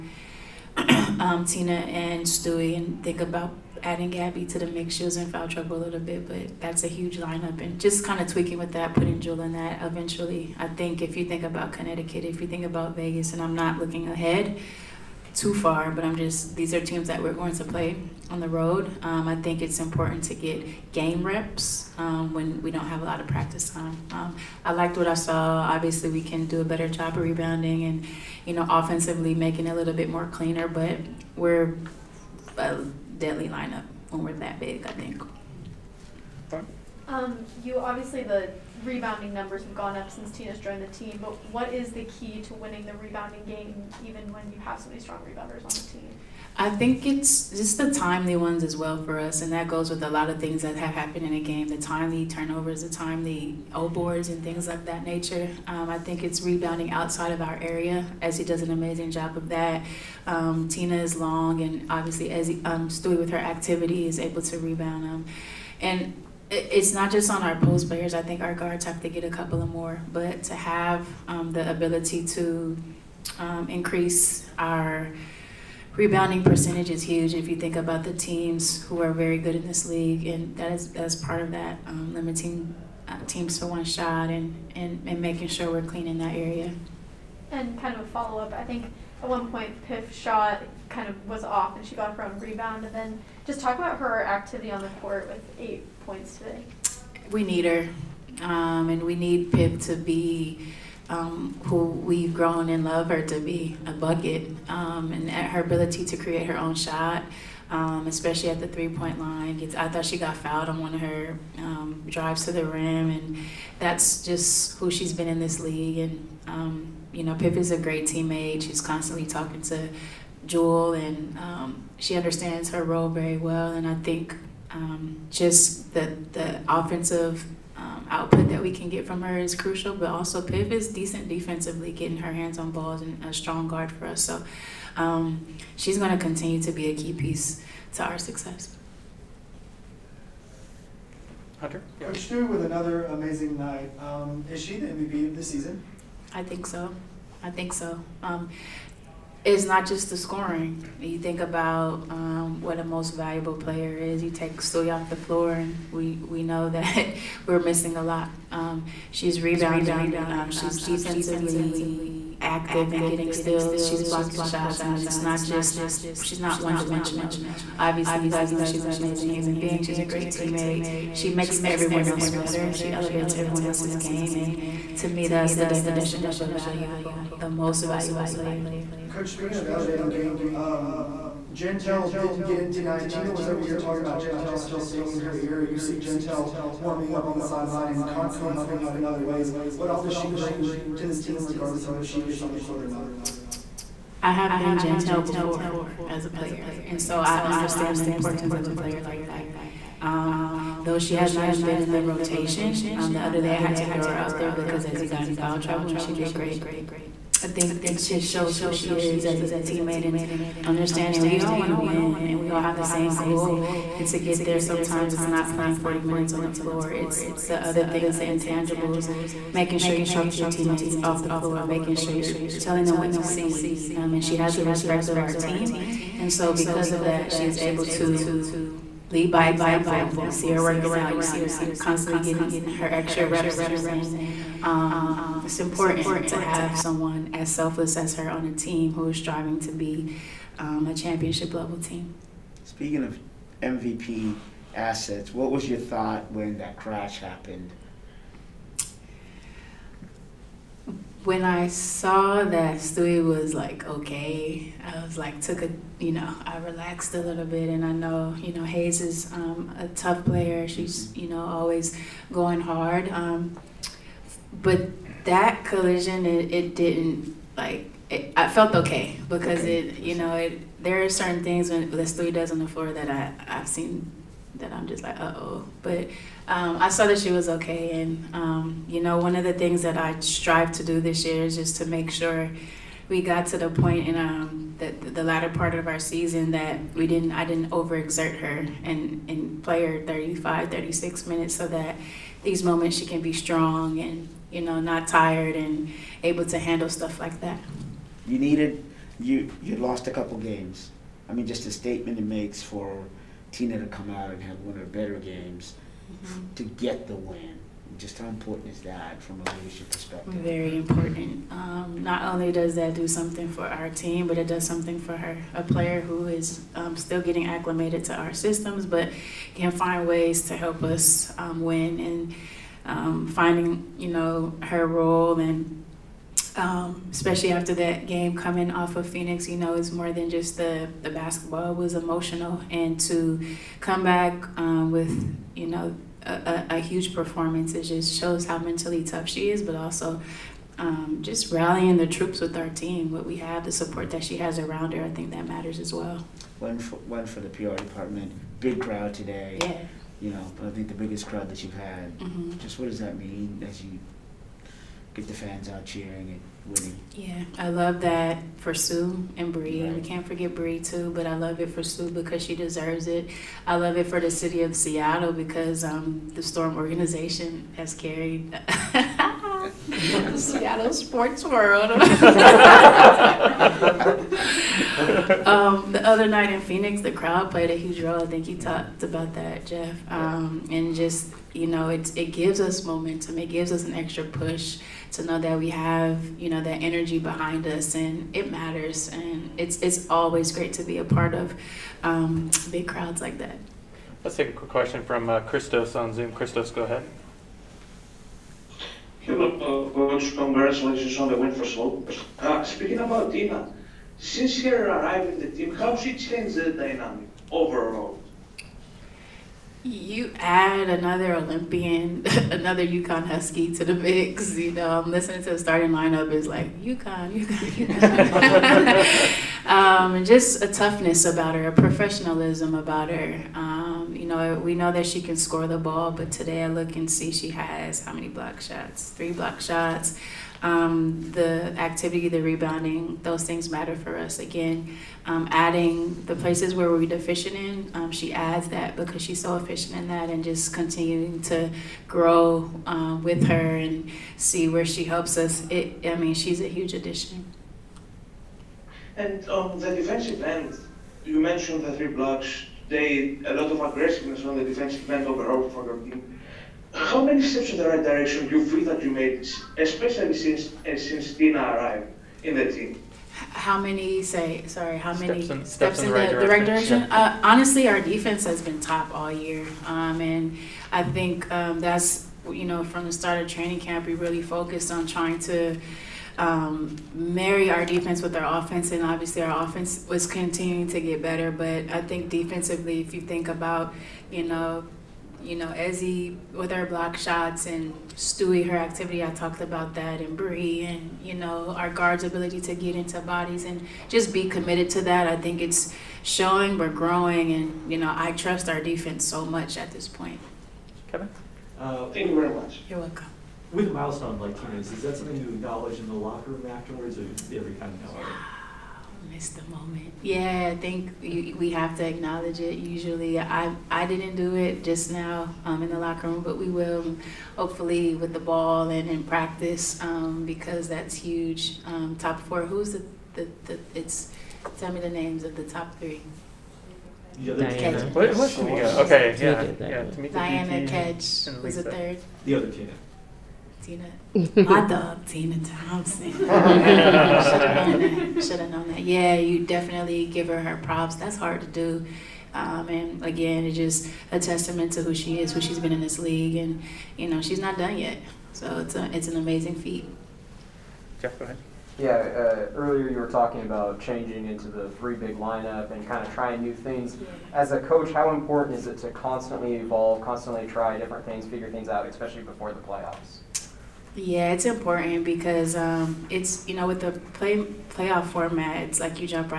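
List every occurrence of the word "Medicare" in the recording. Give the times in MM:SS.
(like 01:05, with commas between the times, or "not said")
not said.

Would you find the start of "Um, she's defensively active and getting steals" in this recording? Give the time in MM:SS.
02:40.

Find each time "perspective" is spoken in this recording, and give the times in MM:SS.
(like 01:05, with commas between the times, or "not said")
05:09.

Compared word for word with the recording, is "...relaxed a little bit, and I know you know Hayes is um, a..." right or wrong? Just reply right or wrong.
right.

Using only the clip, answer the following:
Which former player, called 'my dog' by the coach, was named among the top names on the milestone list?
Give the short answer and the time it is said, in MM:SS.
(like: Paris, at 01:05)
Tina Thompson, at 08:55.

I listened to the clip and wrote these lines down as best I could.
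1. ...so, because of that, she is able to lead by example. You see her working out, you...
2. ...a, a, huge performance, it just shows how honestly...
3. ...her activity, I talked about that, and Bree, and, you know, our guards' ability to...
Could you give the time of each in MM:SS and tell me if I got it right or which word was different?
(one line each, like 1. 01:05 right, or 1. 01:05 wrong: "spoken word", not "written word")
1. 03:46 right
2. 05:36 wrong: "mentally", not "honestly"
3. 08:08 right.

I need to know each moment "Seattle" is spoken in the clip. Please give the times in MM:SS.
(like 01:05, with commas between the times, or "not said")
06:04, 06:10.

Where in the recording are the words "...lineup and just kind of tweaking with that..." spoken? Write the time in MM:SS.
00:07.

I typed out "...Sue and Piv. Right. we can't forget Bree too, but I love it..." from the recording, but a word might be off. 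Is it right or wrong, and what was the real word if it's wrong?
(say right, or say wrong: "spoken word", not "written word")
wrong: "Bree", not "Piv".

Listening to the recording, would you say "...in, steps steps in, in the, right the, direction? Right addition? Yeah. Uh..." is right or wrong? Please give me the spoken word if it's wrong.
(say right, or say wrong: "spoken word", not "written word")
wrong: "direction", not "addition".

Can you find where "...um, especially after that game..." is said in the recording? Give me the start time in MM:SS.
05:26.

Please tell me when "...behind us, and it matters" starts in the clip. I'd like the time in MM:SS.
06:27.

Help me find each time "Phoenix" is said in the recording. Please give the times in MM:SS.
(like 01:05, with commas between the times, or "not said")
05:29, 06:16.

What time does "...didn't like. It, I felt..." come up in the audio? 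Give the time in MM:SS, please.
04:26.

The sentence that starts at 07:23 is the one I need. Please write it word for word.
her and see where she helps us.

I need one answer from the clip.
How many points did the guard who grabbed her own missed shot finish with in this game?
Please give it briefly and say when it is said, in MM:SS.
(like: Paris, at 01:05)
8, at 01:35.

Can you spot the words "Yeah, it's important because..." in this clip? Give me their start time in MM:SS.
09:24.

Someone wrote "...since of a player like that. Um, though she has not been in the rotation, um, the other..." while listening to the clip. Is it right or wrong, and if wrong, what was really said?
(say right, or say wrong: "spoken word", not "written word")
wrong: "importance", not "since".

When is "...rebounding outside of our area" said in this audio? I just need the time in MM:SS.
00:56.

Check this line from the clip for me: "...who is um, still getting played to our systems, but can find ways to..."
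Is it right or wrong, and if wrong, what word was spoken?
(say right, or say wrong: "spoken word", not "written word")
wrong: "acclimated", not "played".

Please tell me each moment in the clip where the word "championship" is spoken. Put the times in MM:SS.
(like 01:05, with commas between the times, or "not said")
04:00.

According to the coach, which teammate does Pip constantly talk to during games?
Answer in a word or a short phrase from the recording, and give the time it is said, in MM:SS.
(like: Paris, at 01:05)
Jewel, at 01:58.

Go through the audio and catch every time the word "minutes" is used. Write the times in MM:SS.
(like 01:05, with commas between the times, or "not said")
03:36, 04:51.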